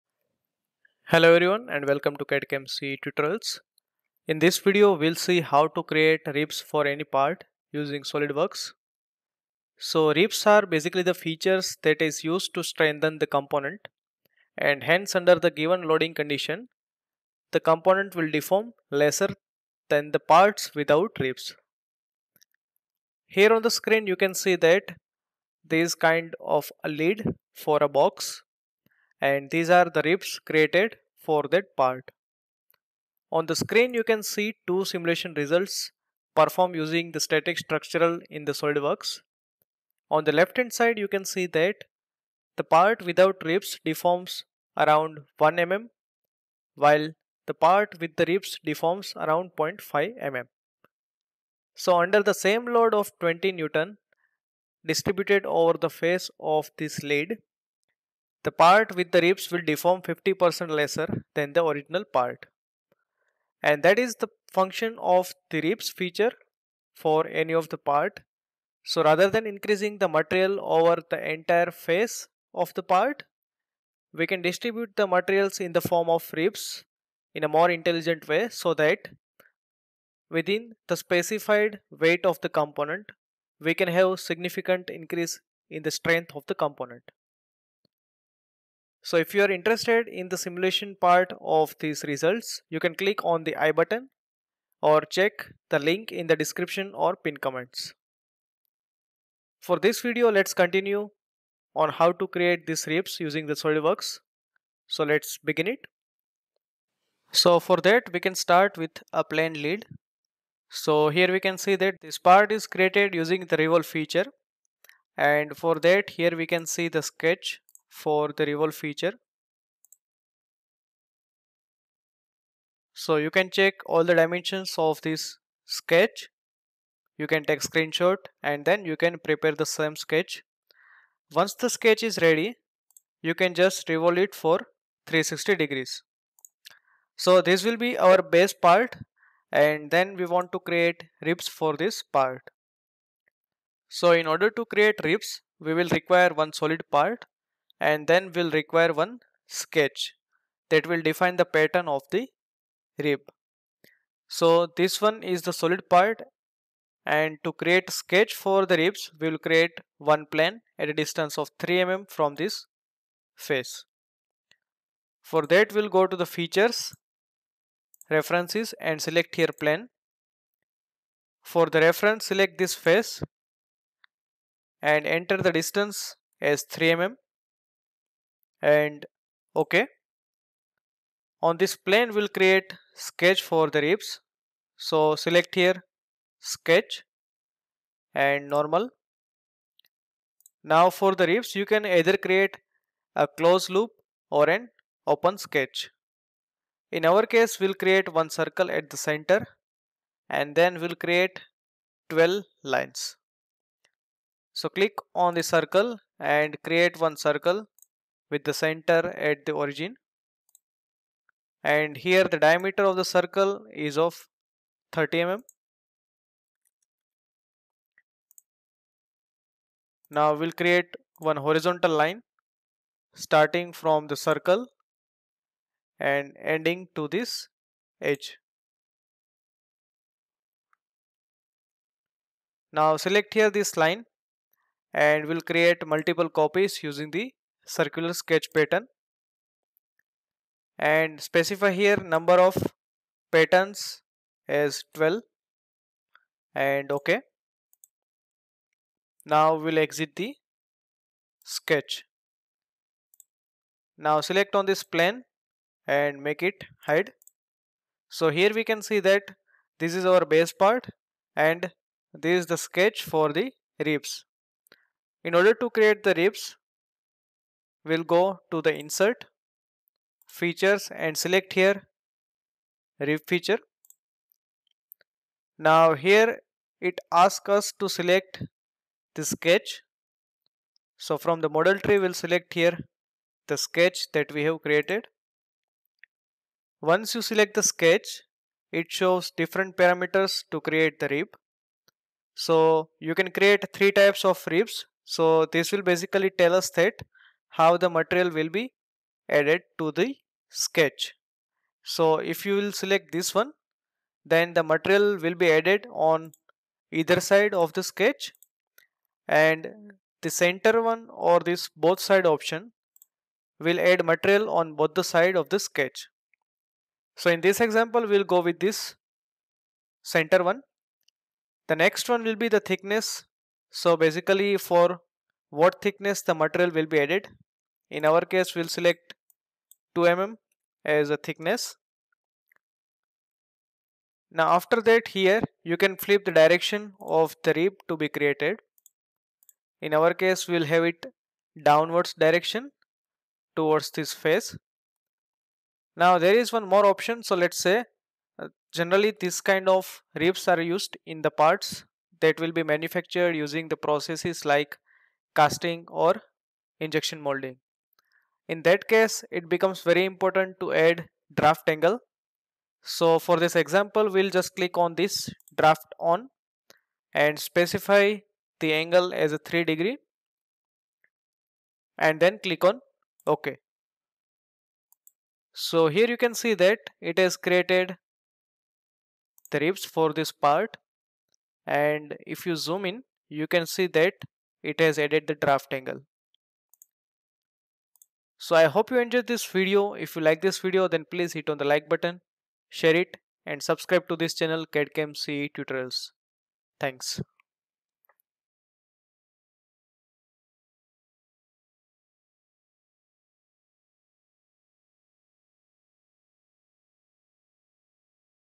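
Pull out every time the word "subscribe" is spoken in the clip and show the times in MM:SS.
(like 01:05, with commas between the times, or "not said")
06:33.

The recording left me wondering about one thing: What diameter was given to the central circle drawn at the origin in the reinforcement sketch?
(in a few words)
30 mm.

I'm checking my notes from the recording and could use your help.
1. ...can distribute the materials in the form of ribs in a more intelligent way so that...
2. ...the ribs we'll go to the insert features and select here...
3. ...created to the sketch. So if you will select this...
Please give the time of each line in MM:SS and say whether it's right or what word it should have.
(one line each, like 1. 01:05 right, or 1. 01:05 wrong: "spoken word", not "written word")
1. 01:14 right
2. 04:26 right
3. 04:59 wrong: "added", not "created".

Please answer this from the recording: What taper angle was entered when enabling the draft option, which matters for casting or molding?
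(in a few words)
3 degrees.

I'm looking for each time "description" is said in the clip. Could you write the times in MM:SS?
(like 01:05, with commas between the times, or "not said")
01:36.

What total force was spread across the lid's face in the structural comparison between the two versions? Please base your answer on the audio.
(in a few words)
20 Newton.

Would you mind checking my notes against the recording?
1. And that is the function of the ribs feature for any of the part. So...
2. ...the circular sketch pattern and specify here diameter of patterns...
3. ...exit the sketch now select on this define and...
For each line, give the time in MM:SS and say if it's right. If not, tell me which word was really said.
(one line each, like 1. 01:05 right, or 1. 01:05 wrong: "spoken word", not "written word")
1. 01:03 right
2. 03:57 wrong: "number", not "diameter"
3. 04:09 wrong: "plane", not "define".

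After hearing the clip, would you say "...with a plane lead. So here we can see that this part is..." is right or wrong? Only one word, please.
right.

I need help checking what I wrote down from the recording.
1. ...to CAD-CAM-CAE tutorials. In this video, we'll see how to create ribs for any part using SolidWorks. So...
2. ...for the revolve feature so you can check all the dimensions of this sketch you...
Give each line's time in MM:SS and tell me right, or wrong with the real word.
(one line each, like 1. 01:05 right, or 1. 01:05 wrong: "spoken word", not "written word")
1. 00:02 right
2. 01:57 right.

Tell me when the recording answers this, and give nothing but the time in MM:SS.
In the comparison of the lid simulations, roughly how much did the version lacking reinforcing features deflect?
00:45.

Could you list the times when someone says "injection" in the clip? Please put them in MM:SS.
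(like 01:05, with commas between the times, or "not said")
05:56.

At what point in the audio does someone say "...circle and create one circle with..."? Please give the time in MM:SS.
03:25.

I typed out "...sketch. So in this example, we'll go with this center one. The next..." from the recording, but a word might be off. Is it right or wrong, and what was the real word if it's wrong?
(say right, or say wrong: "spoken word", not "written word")
right.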